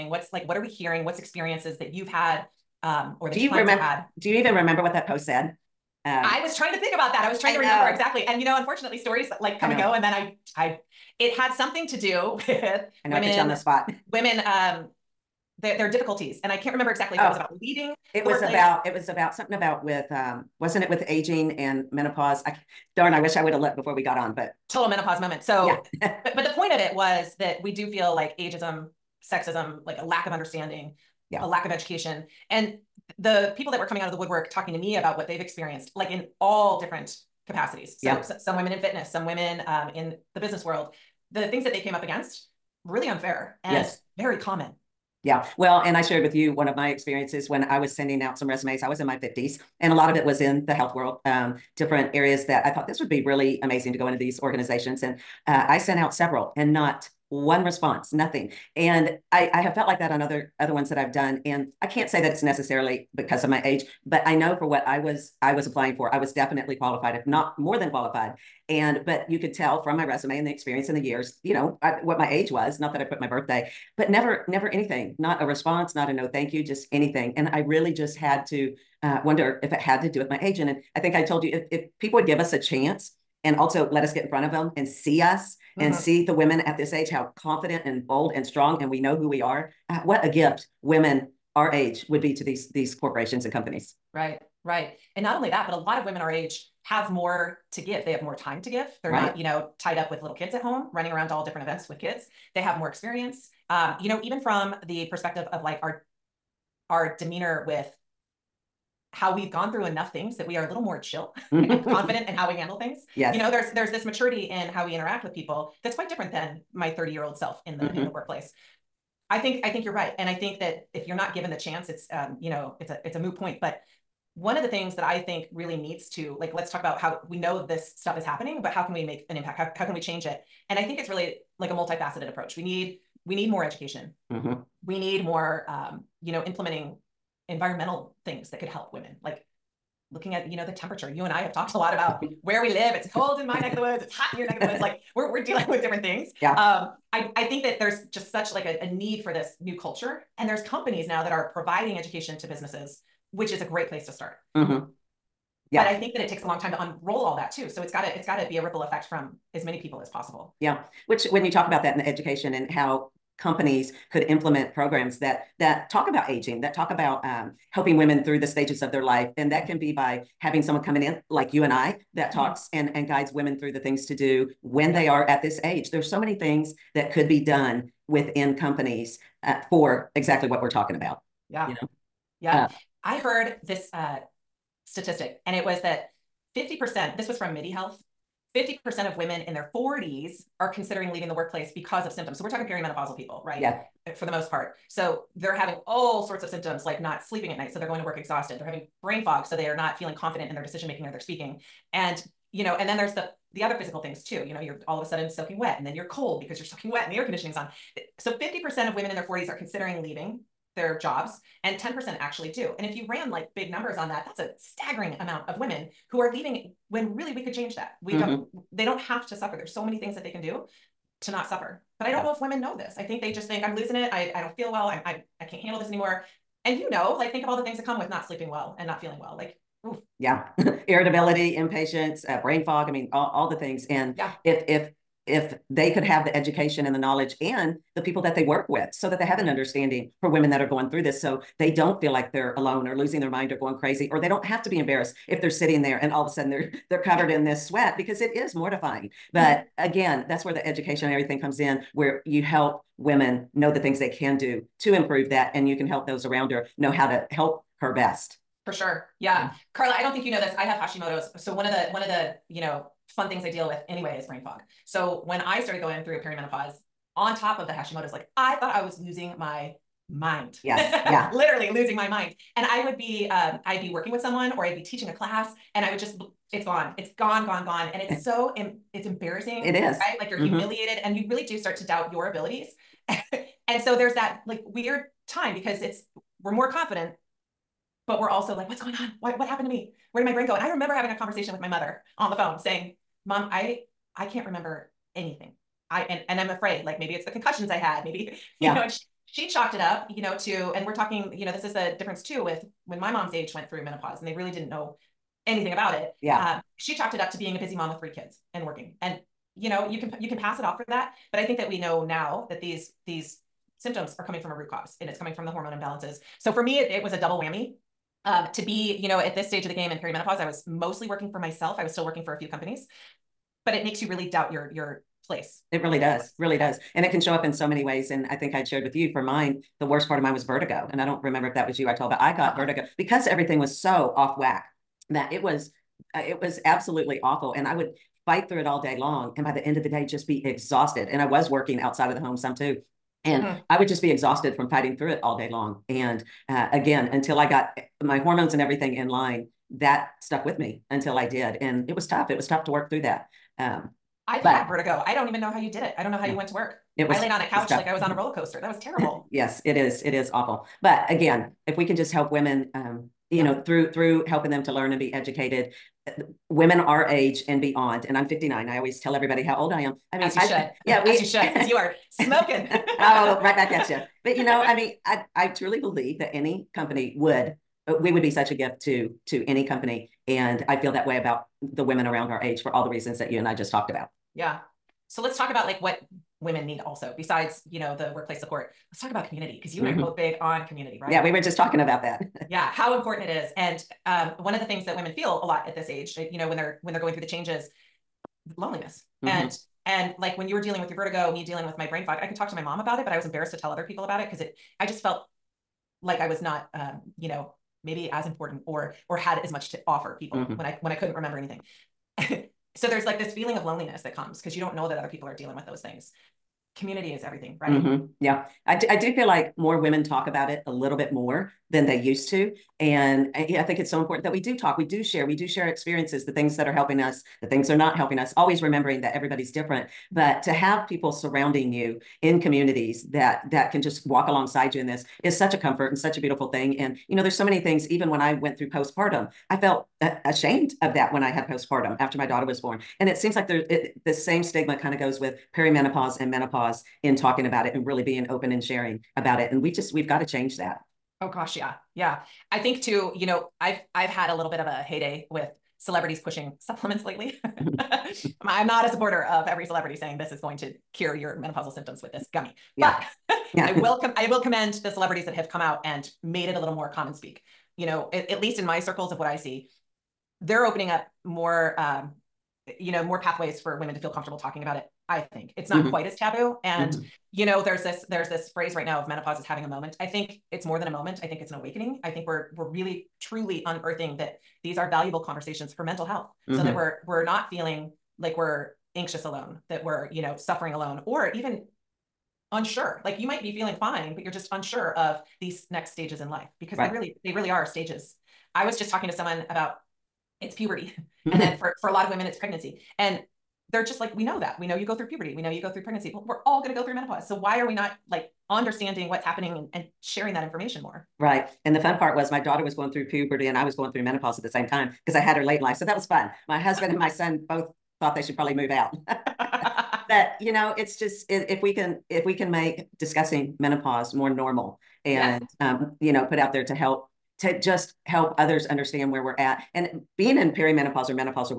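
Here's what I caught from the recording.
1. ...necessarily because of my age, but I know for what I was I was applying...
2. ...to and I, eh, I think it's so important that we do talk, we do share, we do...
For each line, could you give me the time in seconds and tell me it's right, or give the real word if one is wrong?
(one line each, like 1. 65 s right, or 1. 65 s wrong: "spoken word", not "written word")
1. 62 s right
2. 422 s right.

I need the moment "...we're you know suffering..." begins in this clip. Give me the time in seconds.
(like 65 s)
489 s.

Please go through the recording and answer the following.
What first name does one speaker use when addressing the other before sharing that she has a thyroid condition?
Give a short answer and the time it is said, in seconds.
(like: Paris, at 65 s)
Carla, at 259 s.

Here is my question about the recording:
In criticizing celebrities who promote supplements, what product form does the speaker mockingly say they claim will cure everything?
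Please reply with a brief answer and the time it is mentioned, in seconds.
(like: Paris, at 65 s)
gummy, at 462 s.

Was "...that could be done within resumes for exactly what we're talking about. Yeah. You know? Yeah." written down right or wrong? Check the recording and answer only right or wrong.
wrong.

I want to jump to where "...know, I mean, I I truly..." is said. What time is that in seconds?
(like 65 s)
374 s.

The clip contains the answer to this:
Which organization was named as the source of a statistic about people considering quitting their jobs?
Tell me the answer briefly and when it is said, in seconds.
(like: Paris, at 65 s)
MIDI Health, at 187 s.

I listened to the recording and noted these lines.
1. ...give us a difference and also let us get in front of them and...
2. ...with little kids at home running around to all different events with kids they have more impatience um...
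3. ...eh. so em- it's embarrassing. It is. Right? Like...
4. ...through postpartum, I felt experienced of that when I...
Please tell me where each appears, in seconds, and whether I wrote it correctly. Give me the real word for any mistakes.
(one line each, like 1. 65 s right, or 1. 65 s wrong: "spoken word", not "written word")
1. 82 s wrong: "chance", not "difference"
2. 100 s wrong: "experience", not "impatience"
3. 278 s right
4. 438 s wrong: "ashamed", not "experienced".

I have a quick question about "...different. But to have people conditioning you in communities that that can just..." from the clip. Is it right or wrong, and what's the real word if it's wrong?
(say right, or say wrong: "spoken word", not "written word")
wrong: "surrounding", not "conditioning".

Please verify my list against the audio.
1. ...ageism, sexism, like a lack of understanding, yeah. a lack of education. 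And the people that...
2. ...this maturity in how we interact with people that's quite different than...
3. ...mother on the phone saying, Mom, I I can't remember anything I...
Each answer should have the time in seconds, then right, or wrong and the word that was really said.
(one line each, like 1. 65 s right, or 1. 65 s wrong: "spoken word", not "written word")
1. 28 s right
2. 113 s right
3. 291 s right.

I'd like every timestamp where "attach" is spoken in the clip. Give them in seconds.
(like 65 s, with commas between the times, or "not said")
not said.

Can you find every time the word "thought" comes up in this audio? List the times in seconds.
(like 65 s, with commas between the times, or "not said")
52 s, 268 s, 518 s.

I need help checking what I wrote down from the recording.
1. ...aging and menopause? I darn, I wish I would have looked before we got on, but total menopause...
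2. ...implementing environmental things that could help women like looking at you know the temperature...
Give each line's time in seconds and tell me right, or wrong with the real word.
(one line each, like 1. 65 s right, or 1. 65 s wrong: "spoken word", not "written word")
1. 21 s right
2. 136 s right.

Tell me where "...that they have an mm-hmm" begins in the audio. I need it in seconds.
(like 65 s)
239 s.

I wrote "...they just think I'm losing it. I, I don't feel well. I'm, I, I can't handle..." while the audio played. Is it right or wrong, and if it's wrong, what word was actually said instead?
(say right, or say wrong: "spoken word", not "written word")
right.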